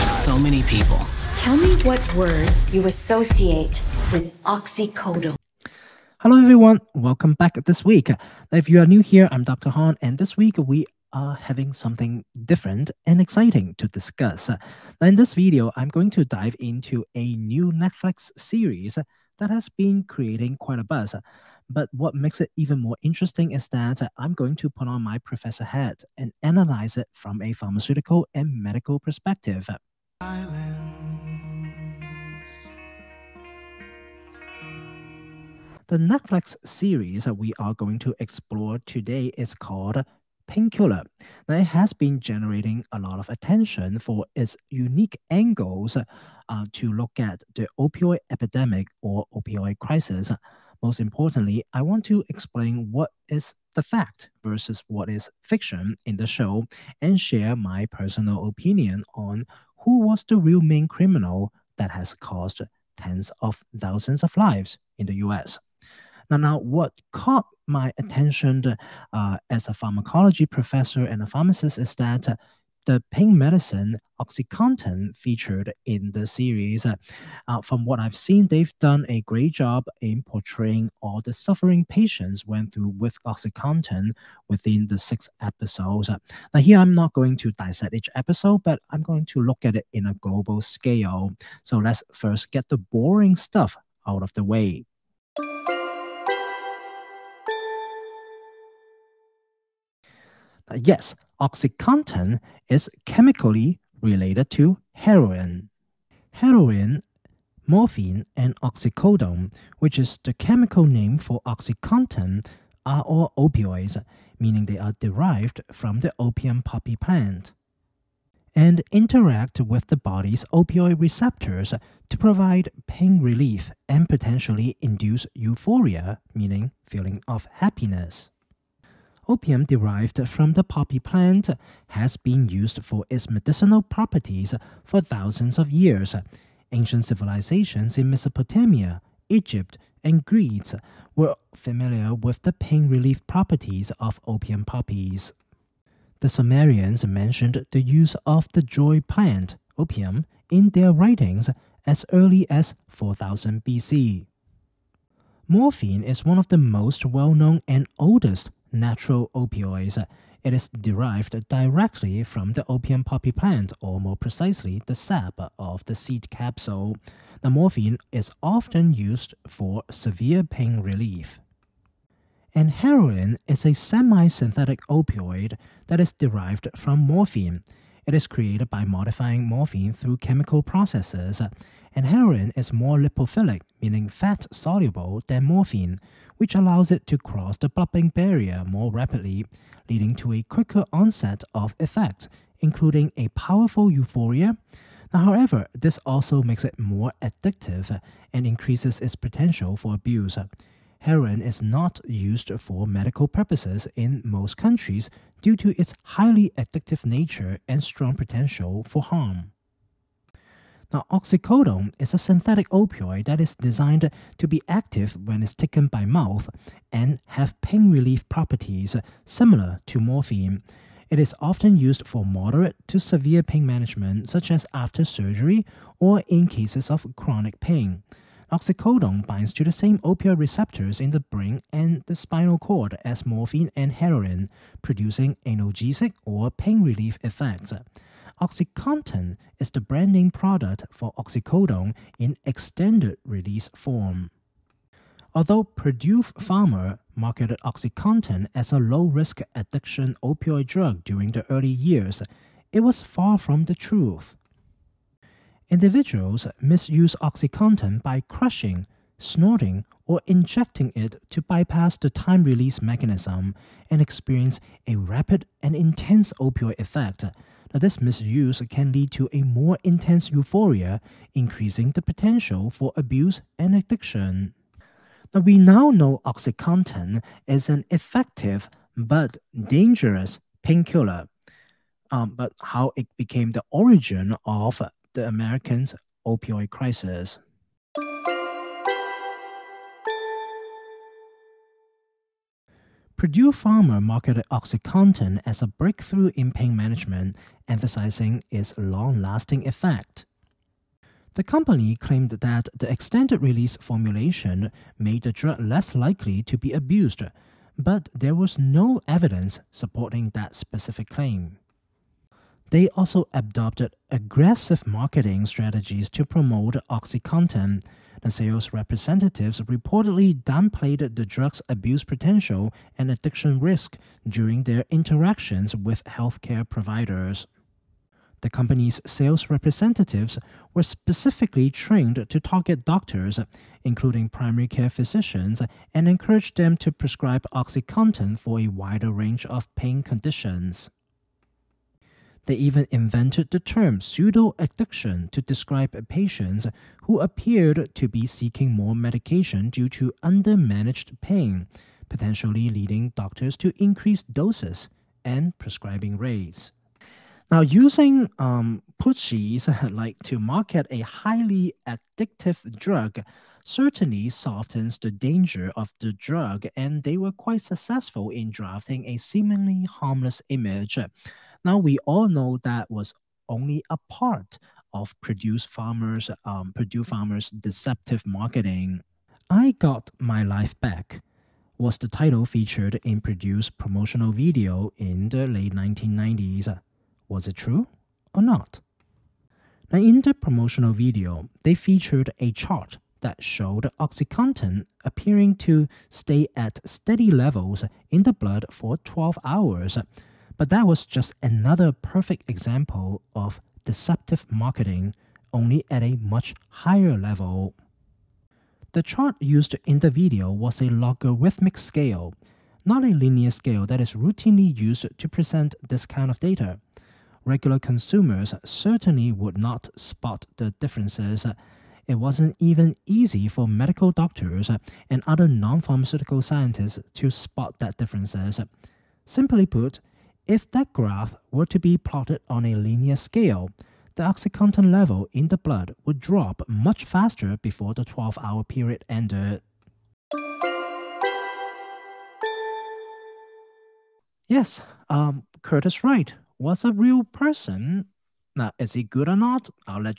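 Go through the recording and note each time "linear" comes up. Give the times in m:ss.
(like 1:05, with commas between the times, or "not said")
6:53, 7:12.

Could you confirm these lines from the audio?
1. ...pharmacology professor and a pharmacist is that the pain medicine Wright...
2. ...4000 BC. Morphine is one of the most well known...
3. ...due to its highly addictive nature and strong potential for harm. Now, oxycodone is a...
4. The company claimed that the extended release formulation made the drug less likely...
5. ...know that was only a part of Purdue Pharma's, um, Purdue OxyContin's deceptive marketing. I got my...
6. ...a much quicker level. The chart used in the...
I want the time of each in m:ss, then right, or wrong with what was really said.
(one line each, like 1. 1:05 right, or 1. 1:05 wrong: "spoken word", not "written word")
1. 1:09 wrong: "OxyContin", not "Wright"
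2. 2:32 right
3. 3:25 right
4. 5:01 right
5. 6:12 wrong: "Pharma", not "OxyContin"
6. 6:46 wrong: "higher", not "quicker".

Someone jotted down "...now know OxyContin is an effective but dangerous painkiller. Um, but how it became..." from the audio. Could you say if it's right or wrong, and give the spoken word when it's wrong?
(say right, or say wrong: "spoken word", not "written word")
right.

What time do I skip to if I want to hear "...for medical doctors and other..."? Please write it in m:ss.
7:03.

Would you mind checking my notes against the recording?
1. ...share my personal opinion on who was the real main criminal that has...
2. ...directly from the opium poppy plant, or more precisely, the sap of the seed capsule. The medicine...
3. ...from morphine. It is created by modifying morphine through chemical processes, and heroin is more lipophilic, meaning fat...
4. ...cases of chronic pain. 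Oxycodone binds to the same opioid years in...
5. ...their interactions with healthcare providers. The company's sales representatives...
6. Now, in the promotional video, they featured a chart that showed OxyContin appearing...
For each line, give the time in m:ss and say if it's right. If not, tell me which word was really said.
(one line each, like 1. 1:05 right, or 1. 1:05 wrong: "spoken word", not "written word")
1. 0:57 right
2. 2:41 wrong: "morphine", not "medicine"
3. 2:56 right
4. 3:46 wrong: "receptors", not "years"
5. 5:24 right
6. 6:29 right.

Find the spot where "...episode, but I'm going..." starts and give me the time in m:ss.
1:28.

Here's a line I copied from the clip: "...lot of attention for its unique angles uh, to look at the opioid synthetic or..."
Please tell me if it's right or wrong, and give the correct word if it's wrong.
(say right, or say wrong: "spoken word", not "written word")
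wrong: "epidemic", not "synthetic".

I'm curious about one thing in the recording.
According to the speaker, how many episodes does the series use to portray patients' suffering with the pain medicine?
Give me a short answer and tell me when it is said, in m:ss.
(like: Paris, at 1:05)
6, at 1:24.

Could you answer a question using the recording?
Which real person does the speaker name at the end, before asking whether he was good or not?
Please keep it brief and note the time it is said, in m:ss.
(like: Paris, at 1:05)
Curtis Wright, at 7:25.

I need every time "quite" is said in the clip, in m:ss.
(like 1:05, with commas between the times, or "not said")
0:20, 6:07.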